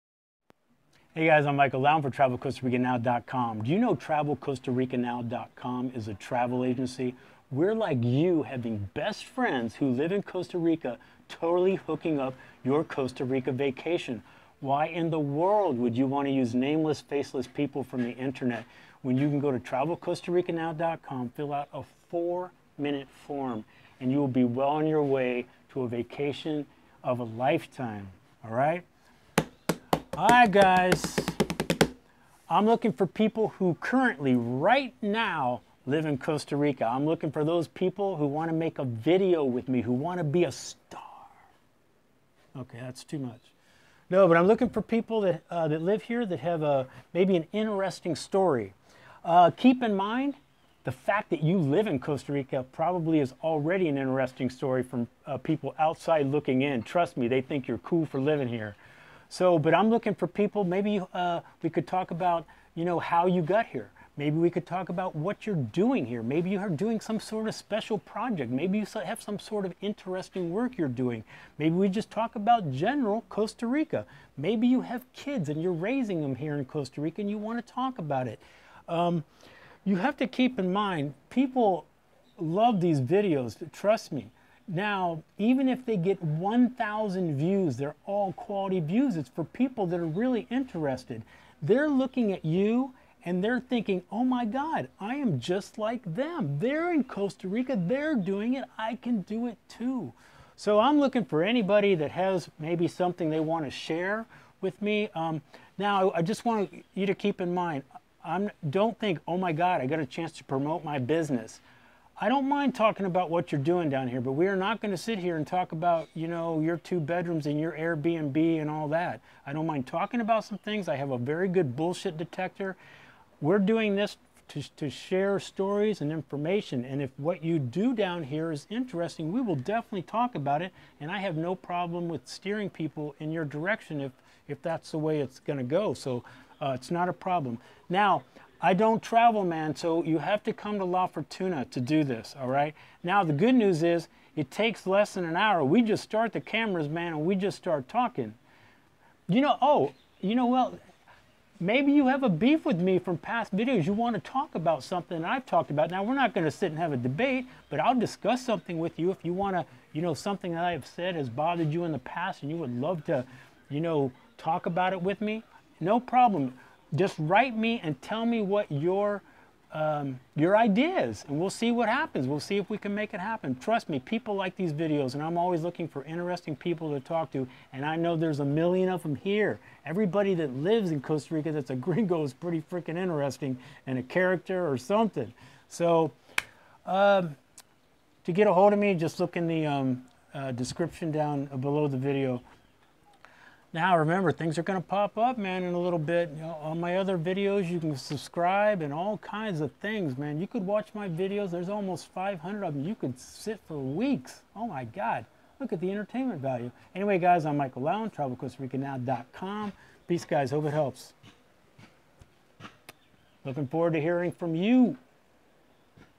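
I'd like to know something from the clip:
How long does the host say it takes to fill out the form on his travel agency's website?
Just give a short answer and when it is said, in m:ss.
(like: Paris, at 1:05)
4 minutes, at 0:22.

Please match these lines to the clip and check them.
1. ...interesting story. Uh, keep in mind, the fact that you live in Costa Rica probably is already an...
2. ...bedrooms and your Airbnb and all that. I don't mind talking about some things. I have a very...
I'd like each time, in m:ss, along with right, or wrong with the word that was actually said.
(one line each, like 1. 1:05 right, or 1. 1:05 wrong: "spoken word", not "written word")
1. 0:47 right
2. 1:56 right.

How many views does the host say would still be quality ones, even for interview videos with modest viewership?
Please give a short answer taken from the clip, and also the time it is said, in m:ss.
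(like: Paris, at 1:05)
1,000, at 1:26.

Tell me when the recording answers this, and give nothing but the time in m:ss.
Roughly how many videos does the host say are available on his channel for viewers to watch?
3:21.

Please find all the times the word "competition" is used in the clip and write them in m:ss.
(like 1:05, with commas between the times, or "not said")
not said.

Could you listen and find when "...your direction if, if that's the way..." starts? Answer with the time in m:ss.
2:13.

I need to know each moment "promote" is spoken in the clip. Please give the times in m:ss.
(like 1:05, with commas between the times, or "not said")
1:50.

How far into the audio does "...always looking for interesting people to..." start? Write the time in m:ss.
2:55.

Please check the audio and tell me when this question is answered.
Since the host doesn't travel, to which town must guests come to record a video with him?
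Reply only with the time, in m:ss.
2:20.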